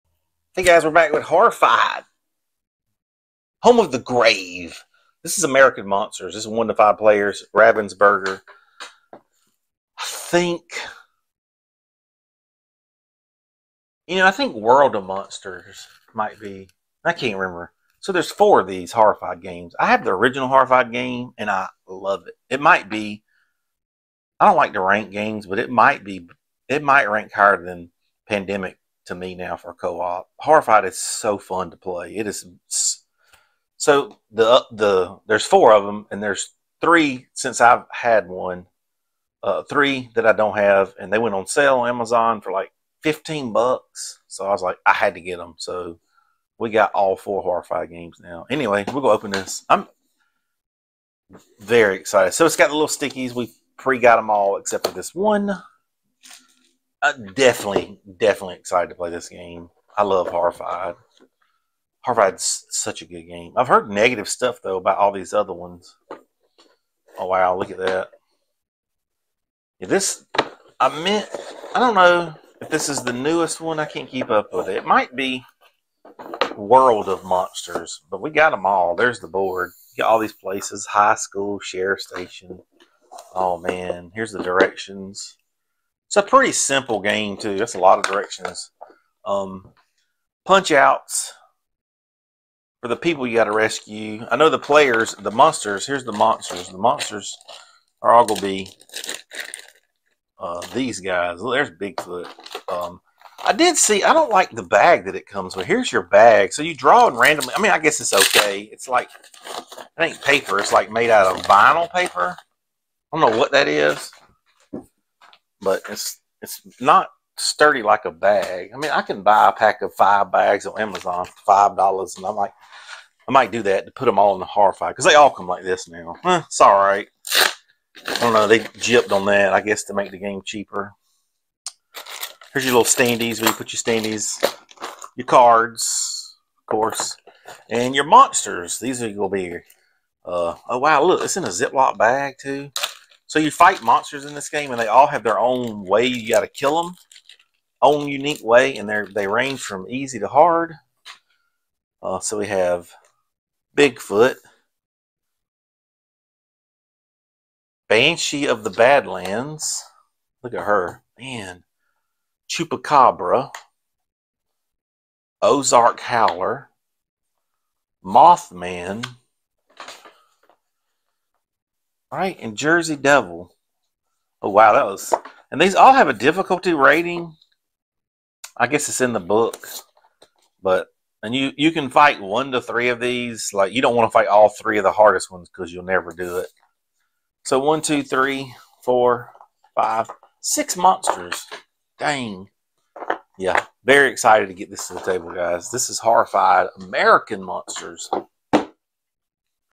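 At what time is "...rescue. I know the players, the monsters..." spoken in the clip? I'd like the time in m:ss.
1:33.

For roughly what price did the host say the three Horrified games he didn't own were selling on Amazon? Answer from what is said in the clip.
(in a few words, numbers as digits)
$15.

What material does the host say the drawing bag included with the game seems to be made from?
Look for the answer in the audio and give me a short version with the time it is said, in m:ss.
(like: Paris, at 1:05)
vinyl paper, at 1:51.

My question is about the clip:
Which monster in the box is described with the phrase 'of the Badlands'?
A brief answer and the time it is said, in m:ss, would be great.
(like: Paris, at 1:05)
Banshee, at 2:37.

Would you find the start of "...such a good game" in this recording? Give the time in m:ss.
1:02.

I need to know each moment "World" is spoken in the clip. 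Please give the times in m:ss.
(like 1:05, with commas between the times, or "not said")
0:14, 1:16.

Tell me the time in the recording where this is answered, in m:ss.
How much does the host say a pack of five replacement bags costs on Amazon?
2:01.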